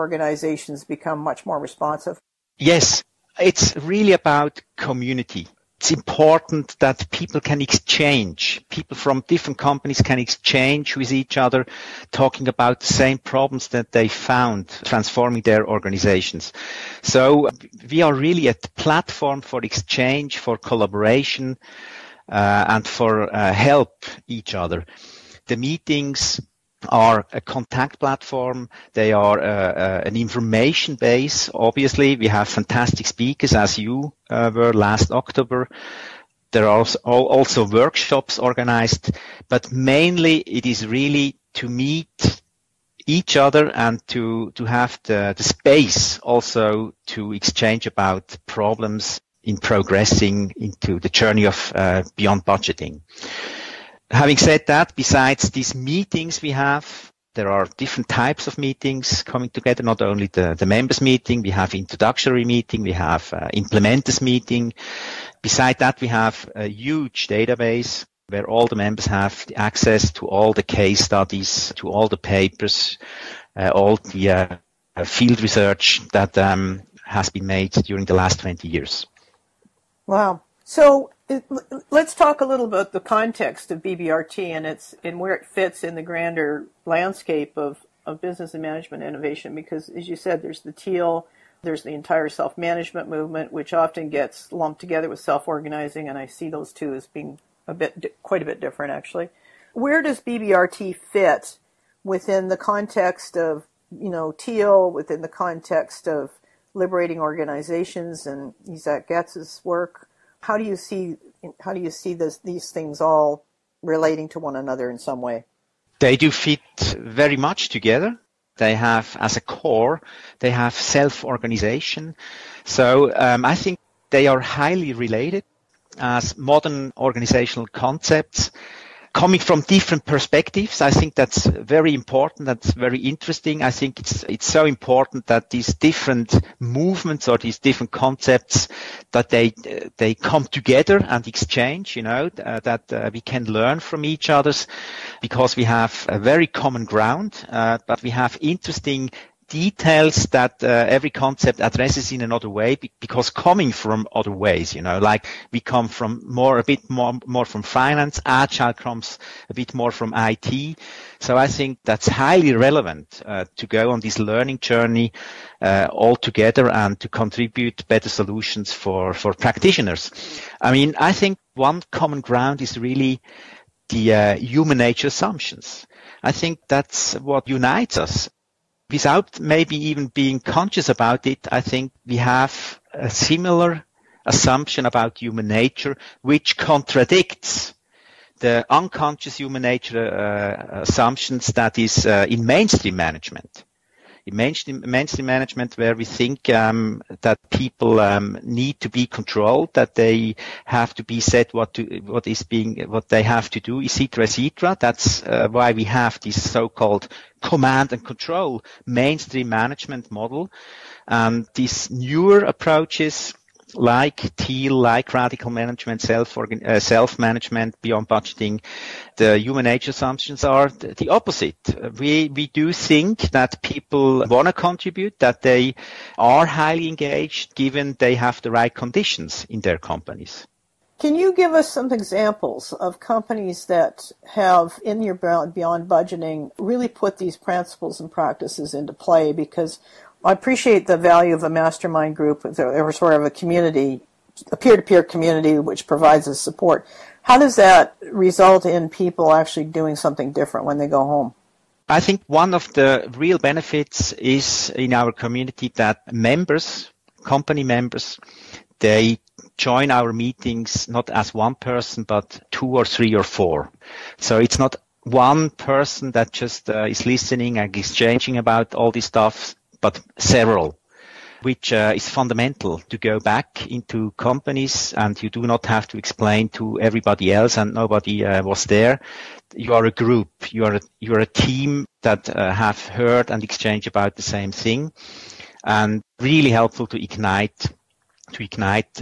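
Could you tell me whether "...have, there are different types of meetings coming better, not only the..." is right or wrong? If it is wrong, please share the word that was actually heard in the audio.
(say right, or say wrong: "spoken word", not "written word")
wrong: "together", not "better".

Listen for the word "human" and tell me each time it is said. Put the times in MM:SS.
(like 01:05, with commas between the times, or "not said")
02:54, 03:05, 03:09, 03:39.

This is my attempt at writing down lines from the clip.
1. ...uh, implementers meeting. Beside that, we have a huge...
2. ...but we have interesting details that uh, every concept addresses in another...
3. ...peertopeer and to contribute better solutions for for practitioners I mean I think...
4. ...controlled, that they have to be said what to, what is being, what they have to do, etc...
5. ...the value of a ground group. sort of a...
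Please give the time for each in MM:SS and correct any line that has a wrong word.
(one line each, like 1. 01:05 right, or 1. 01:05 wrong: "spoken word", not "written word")
1. 01:03 right
2. 02:27 right
3. 02:46 wrong: "together", not "peertopeer"
4. 03:19 right
5. 04:00 wrong: "mastermind", not "ground".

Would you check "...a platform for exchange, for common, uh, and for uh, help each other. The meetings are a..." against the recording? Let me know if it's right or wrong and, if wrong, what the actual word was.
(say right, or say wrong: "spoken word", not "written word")
wrong: "collaboration", not "common".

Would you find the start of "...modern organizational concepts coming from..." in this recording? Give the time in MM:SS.
02:06.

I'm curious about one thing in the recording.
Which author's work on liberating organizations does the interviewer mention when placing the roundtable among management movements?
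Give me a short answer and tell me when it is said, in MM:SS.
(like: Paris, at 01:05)
Isaac Getz, at 01:48.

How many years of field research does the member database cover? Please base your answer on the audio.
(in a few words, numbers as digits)
20 years.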